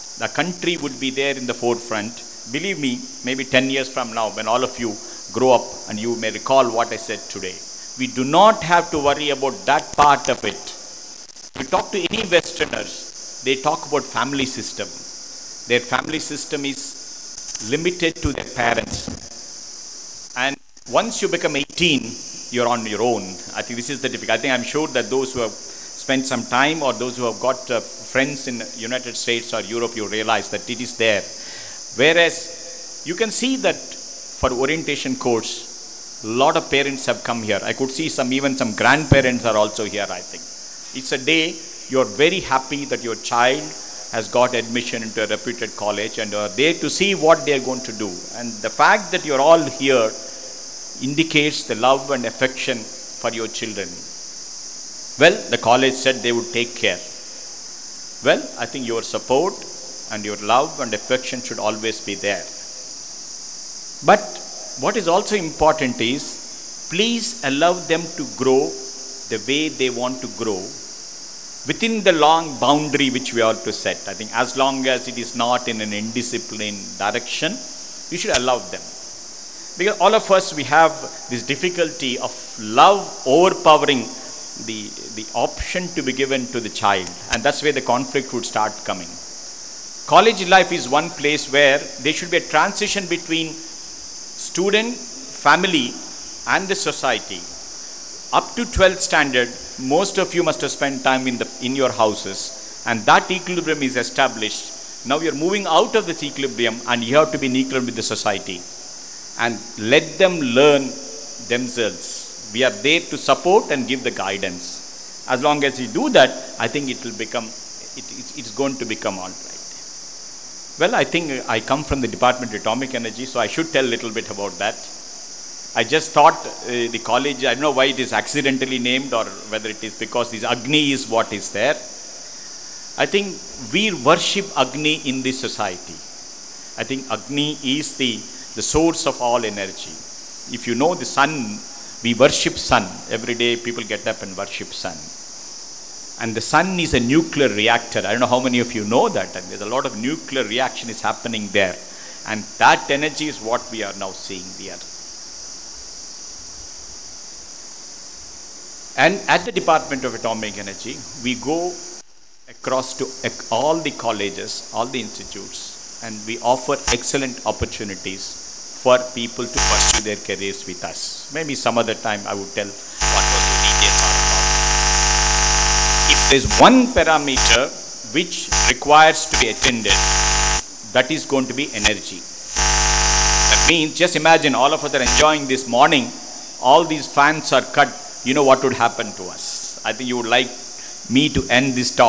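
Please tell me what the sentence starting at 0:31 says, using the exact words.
Whereas you can see that for orientation course, a lot of parents have come here.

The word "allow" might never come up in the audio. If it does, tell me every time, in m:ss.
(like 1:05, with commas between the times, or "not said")
1:07, 1:18.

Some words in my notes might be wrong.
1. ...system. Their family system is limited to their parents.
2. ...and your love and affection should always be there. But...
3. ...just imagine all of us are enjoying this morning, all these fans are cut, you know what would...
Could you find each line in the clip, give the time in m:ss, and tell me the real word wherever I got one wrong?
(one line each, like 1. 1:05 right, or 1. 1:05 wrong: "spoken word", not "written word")
1. 0:14 right
2. 1:00 right
3. 3:03 right.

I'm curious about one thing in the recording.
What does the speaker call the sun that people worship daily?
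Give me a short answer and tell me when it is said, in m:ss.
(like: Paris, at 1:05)
nuclear reactor, at 2:26.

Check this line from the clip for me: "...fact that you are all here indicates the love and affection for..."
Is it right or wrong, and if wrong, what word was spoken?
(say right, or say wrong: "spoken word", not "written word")
right.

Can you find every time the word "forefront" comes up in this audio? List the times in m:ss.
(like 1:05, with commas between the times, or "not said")
0:01.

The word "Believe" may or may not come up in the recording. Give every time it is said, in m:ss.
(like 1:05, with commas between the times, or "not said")
0:02.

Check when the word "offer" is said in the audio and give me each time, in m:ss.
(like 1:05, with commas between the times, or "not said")
2:46.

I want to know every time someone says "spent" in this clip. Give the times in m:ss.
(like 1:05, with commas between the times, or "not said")
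0:25, 1:40.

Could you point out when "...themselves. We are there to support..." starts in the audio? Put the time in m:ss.
1:51.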